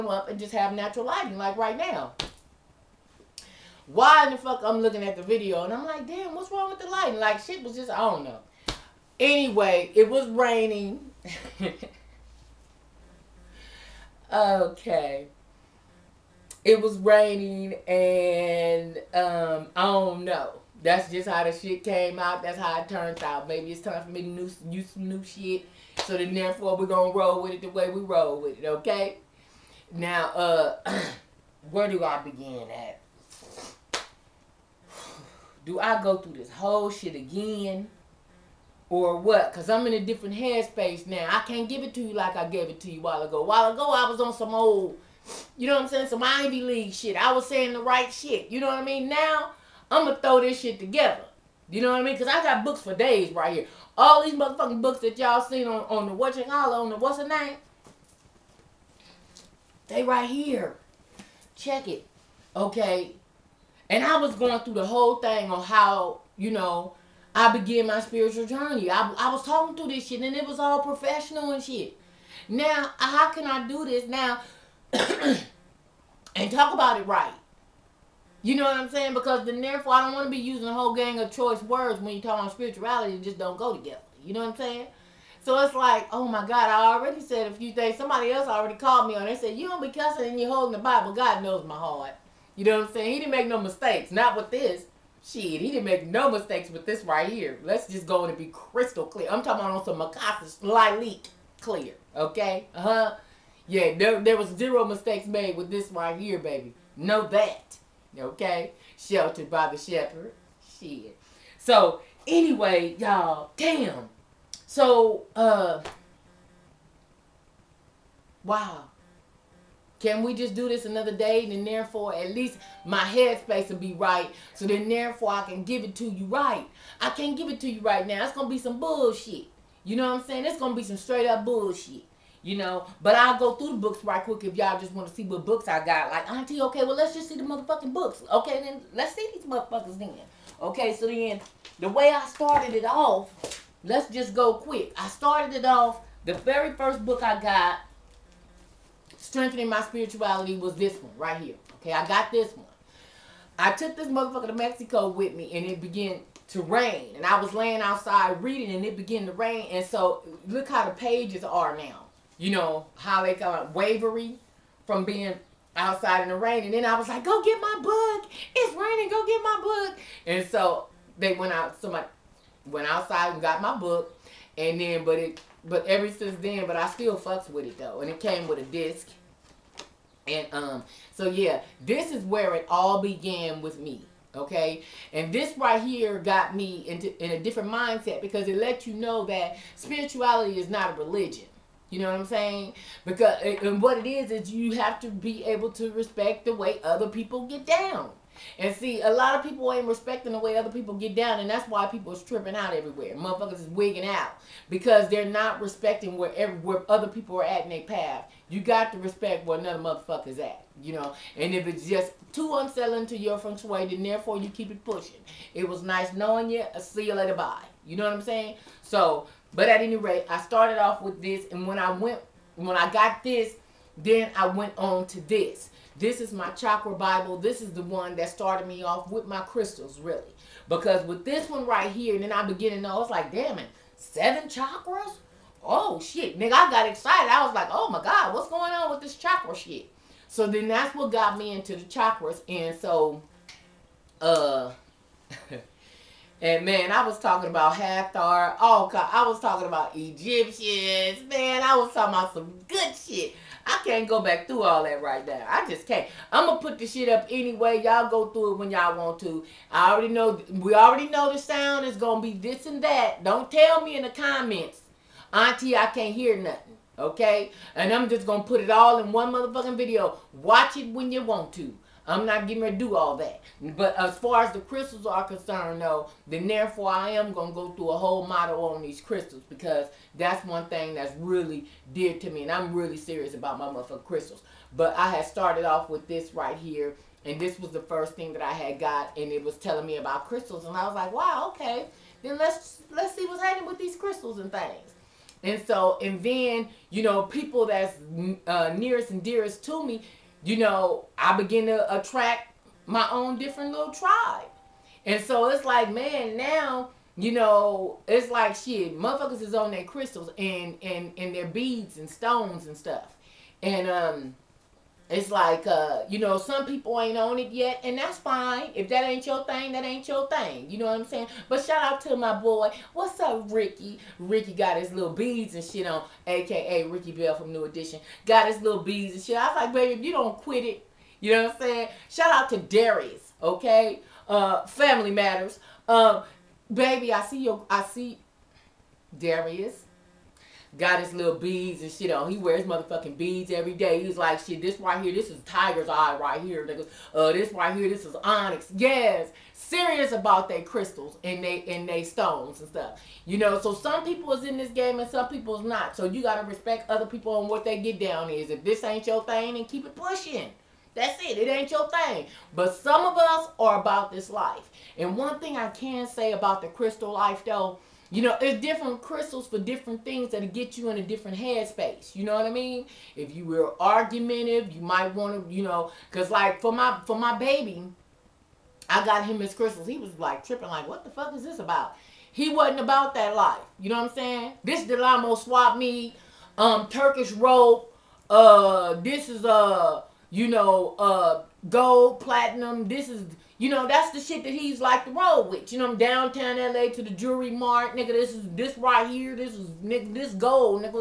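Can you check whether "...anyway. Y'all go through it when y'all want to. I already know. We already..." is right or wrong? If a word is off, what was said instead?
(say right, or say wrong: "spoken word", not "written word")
right.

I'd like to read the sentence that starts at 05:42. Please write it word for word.
He wears motherfucking beads every day.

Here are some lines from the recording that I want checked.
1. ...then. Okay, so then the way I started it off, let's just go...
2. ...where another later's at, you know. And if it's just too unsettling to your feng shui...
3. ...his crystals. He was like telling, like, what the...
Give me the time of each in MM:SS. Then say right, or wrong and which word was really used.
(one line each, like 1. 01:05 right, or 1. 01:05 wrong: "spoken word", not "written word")
1. 02:19 right
2. 03:29 wrong: "motherfucker", not "later"
3. 06:19 wrong: "tripping", not "telling".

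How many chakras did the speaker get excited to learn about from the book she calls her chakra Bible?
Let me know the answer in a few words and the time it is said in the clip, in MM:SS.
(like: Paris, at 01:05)
7, at 03:53.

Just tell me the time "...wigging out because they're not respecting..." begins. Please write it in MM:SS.
03:23.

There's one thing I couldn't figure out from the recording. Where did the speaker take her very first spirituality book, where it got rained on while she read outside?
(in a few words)
Mexico.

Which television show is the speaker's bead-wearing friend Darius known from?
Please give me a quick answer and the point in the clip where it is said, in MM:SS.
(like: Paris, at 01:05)
Family Matters, at 05:34.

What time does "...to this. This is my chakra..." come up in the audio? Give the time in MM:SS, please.
03:45.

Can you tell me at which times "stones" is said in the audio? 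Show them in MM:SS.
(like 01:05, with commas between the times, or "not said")
05:12, 05:52.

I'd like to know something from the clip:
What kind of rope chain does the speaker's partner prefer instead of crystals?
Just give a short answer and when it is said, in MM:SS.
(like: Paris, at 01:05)
Turkish rope, at 06:26.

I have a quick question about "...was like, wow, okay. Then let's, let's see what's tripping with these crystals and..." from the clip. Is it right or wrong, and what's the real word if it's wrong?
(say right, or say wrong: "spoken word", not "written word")
wrong: "happening", not "tripping".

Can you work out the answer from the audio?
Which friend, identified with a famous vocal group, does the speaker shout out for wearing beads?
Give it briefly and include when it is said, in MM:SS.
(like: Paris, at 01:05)
Ricky Bell, at 05:26.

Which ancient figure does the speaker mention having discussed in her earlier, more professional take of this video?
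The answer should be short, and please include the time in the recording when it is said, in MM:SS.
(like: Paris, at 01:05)
Hathor, at 04:07.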